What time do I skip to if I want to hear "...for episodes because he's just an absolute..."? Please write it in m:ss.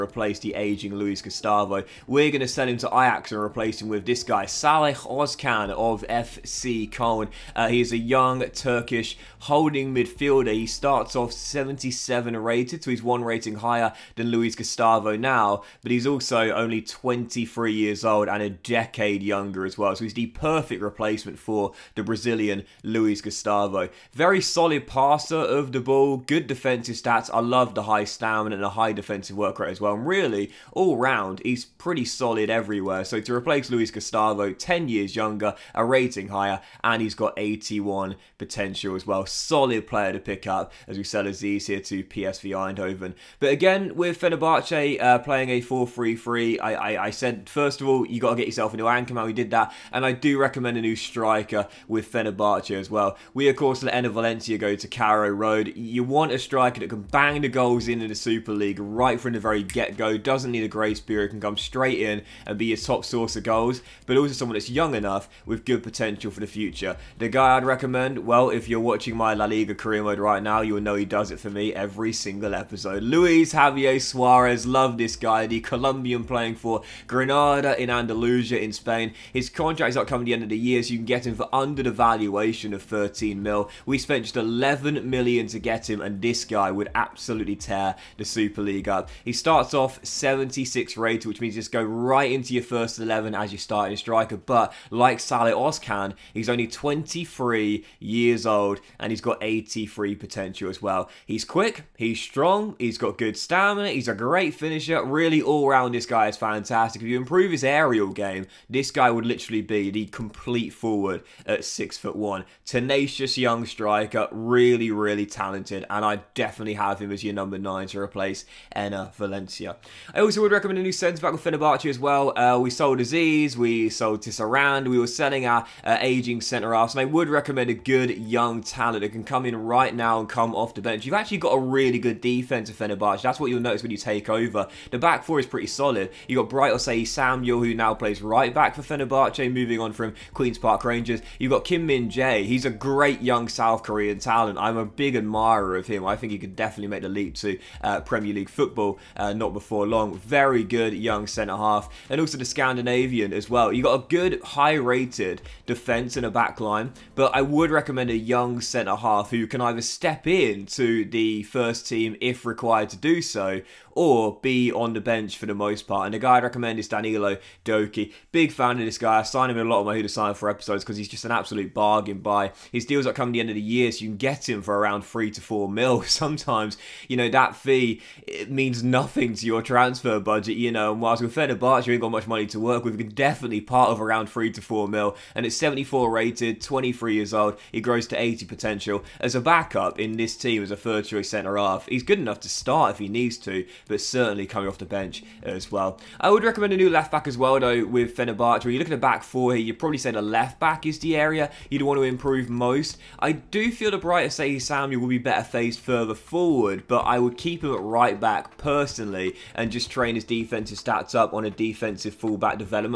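2:50.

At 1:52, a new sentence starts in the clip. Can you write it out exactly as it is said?
Tenacious young striker, really, really talented, and I definitely have him as your number nine to replace Enner Valencia.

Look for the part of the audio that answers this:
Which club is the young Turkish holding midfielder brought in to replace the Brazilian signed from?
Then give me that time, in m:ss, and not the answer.
0:06.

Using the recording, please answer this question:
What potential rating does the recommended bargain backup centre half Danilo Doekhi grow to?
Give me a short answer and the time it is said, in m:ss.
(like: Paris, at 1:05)
80, at 3:08.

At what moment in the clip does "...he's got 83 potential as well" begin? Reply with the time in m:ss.
1:39.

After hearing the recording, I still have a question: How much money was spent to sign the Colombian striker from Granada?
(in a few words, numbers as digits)
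11 million.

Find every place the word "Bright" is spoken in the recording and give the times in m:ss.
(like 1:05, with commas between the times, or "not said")
2:16, 3:24.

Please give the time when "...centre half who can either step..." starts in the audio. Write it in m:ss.
2:38.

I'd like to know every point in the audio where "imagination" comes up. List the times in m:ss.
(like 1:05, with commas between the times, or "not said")
not said.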